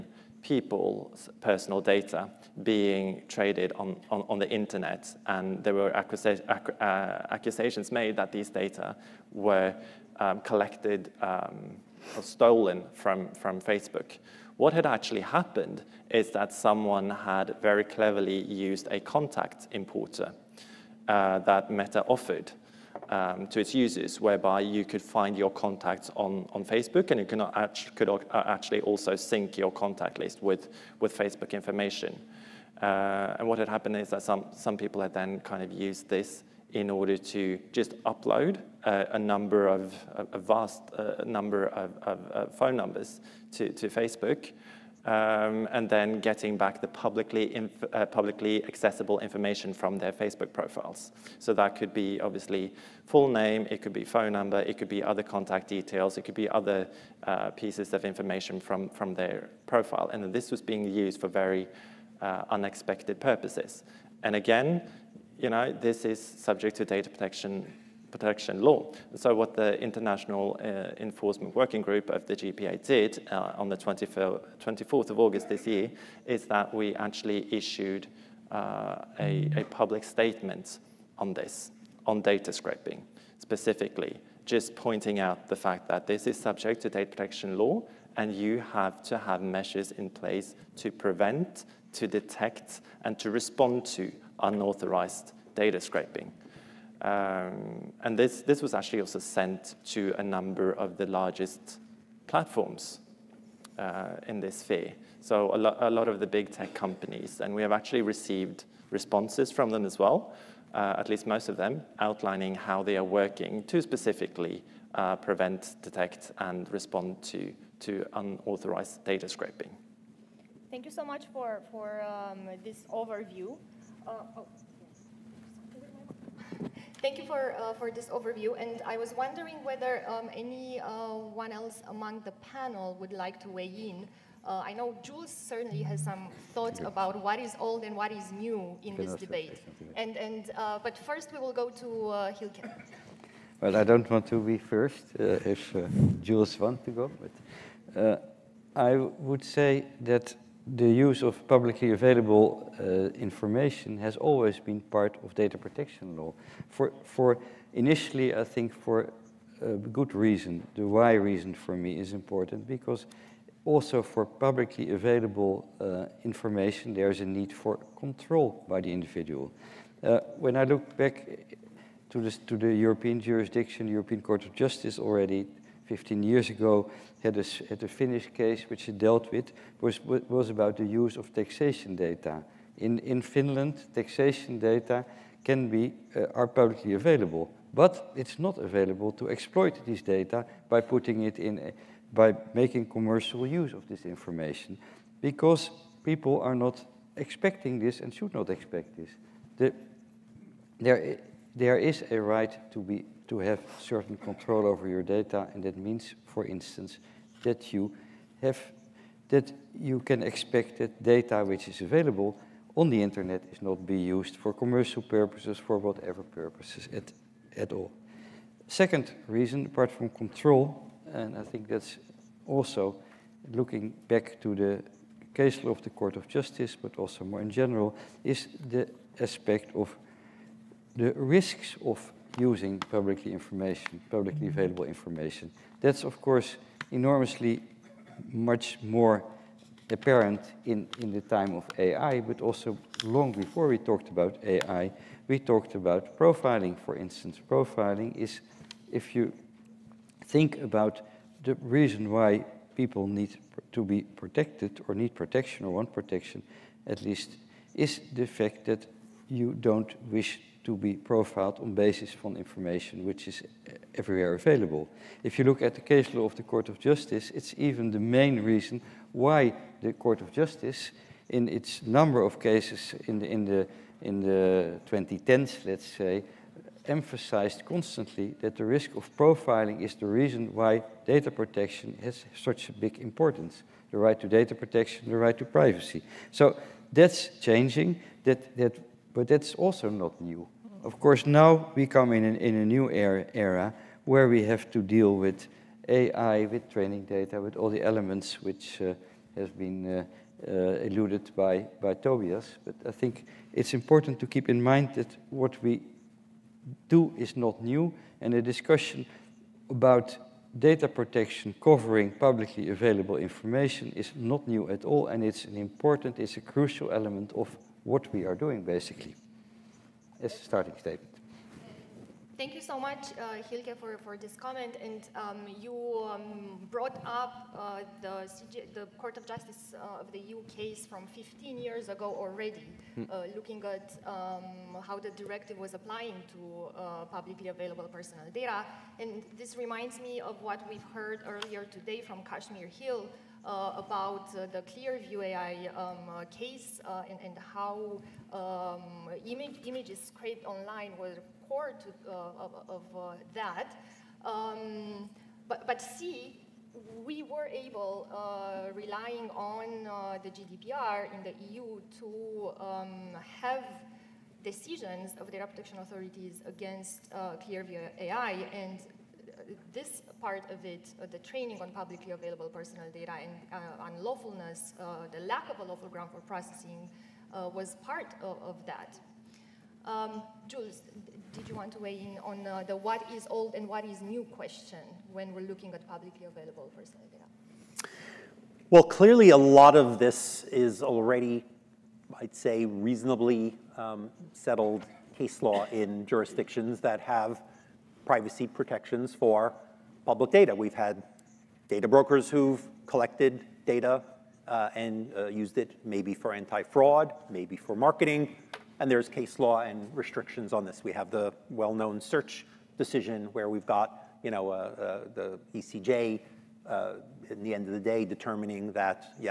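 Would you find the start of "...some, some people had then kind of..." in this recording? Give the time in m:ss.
0:34.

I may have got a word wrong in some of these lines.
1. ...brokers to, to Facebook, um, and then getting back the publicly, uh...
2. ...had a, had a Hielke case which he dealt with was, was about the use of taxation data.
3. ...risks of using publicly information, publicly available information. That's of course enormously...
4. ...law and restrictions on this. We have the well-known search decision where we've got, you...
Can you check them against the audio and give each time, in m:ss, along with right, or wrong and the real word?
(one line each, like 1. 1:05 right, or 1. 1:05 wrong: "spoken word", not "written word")
1. 0:42 wrong: "numbers", not "brokers"
2. 2:57 wrong: "Finnish", not "Hielke"
3. 3:51 right
4. 6:49 right.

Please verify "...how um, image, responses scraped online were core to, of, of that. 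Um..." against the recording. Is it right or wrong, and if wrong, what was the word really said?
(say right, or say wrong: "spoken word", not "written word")
wrong: "images", not "responses".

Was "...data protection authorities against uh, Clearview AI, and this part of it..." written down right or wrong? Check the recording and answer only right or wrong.
right.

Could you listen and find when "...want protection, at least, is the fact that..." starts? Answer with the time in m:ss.
4:15.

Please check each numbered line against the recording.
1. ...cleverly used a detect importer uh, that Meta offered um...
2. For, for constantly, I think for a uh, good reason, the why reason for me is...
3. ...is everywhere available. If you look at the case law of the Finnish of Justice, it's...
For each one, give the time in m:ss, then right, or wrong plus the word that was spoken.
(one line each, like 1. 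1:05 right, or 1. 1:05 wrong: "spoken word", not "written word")
1. 0:17 wrong: "contact", not "detect"
2. 2:36 wrong: "initially", not "constantly"
3. 4:23 wrong: "Court", not "Finnish".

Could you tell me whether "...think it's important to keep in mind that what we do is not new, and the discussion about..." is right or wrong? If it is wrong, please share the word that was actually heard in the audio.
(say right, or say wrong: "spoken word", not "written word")
right.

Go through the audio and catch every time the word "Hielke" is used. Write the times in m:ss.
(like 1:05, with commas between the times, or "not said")
2:22, 5:23.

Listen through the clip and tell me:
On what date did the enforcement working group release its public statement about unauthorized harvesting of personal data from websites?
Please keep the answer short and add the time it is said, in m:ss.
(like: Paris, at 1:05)
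24th of August, at 1:13.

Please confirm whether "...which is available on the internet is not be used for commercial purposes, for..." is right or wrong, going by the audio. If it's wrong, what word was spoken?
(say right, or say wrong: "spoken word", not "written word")
right.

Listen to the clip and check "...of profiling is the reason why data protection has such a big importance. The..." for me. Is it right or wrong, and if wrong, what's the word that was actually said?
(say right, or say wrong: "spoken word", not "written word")
right.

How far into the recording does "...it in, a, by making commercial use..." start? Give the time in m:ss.
3:11.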